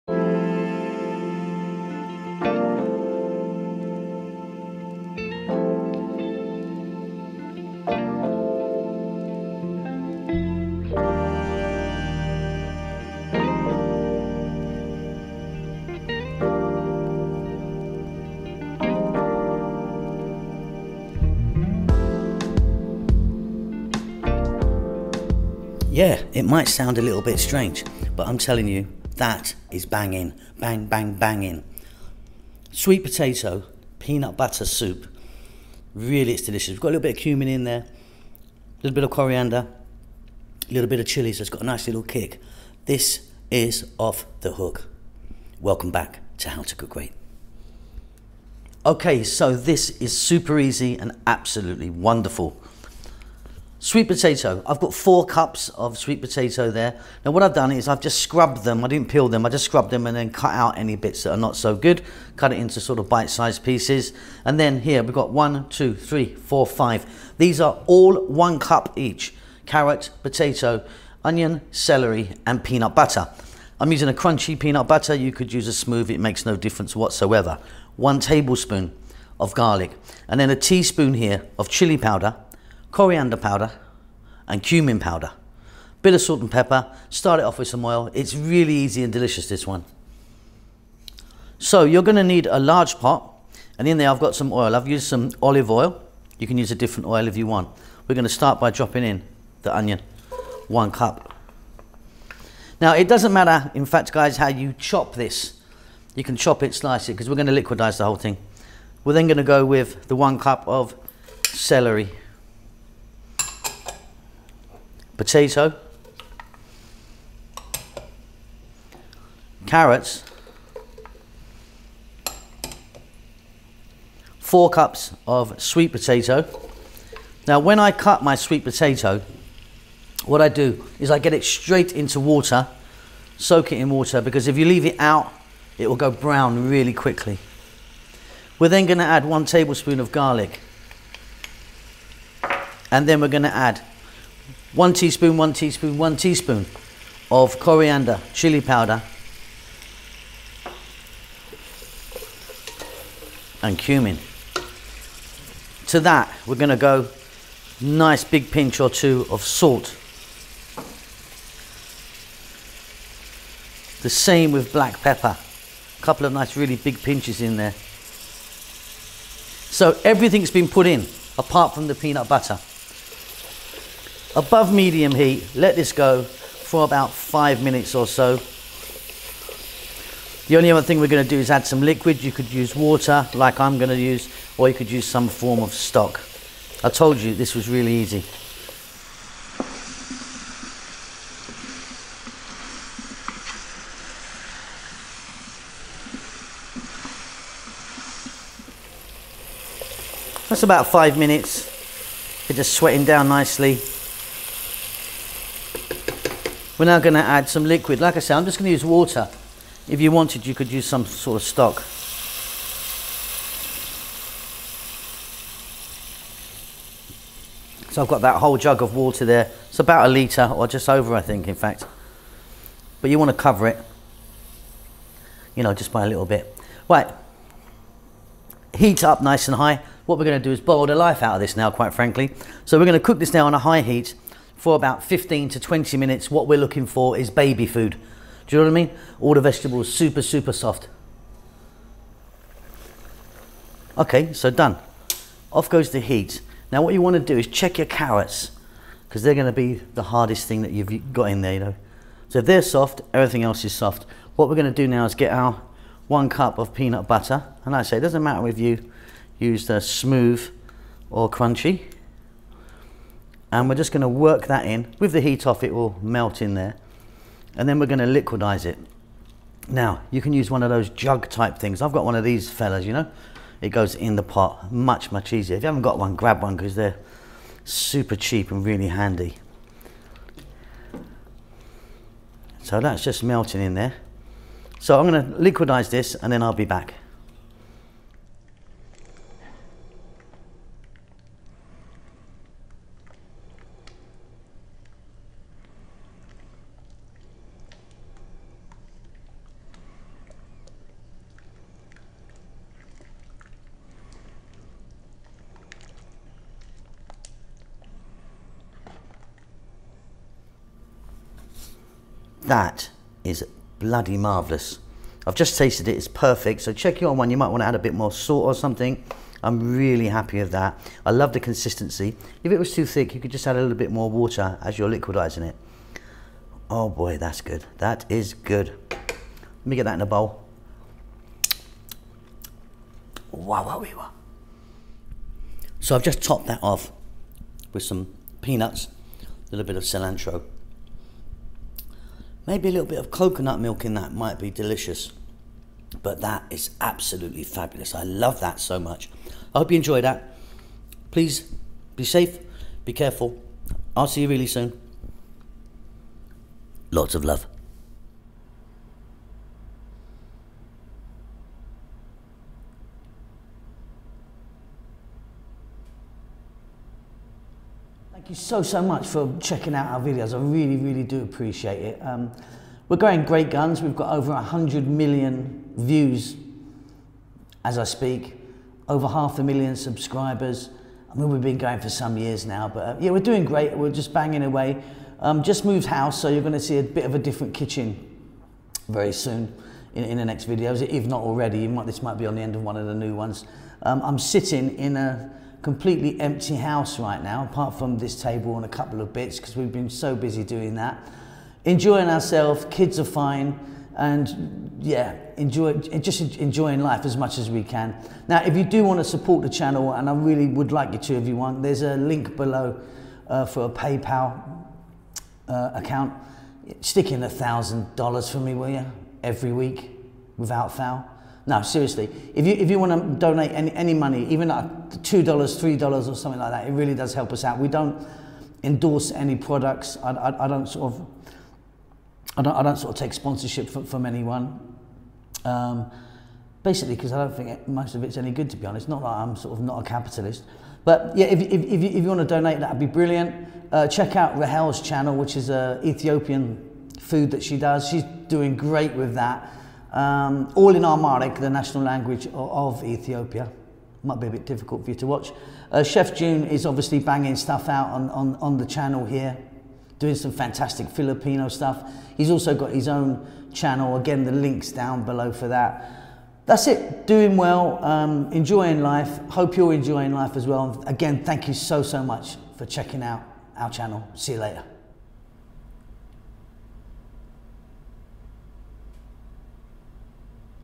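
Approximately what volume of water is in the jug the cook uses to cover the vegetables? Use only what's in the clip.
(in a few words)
a litre.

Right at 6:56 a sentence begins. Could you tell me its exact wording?
Stick in a thousand dollars for me, will you?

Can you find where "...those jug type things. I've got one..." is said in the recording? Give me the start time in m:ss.
4:30.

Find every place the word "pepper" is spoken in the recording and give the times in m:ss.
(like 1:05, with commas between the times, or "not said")
1:26, 2:45.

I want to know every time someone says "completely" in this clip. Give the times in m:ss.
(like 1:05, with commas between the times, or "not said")
6:35.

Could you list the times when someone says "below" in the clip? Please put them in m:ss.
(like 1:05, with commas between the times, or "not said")
6:52, 7:45.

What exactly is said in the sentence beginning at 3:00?
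The only other thing we're going to do is add some liquid.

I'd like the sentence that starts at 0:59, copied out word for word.
I just scrubbed them and then cut out any bits that are not so good.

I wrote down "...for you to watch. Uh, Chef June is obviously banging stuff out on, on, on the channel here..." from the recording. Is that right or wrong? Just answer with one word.
right.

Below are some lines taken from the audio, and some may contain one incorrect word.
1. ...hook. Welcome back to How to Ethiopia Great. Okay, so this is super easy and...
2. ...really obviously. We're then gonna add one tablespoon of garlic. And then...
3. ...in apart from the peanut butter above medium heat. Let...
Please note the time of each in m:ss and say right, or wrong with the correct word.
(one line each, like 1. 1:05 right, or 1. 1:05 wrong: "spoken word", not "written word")
1. 0:44 wrong: "Cook", not "Ethiopia"
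2. 2:16 wrong: "quickly", not "obviously"
3. 2:50 right.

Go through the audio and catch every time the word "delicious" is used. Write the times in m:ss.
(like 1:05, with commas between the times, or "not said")
0:36, 1:29, 5:44.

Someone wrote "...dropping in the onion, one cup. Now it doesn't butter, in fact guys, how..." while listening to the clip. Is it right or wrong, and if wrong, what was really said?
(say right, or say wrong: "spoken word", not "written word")
wrong: "matter", not "butter".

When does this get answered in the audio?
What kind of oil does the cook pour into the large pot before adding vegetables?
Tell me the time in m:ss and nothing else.
1:35.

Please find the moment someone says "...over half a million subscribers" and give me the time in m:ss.
6:18.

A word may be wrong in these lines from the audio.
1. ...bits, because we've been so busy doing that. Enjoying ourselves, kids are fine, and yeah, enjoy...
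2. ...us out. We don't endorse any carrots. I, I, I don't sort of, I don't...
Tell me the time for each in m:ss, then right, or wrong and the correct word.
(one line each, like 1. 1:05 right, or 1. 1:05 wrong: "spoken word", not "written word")
1. 6:39 right
2. 7:07 wrong: "products", not "carrots".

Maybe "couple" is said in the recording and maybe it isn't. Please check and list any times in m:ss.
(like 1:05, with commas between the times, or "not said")
2:46, 6:38.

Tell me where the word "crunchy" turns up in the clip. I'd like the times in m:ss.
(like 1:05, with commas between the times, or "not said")
1:14, 4:21.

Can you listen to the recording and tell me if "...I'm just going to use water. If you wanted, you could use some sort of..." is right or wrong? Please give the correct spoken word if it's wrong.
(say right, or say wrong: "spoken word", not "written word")
right.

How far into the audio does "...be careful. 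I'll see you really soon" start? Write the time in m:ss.
5:52.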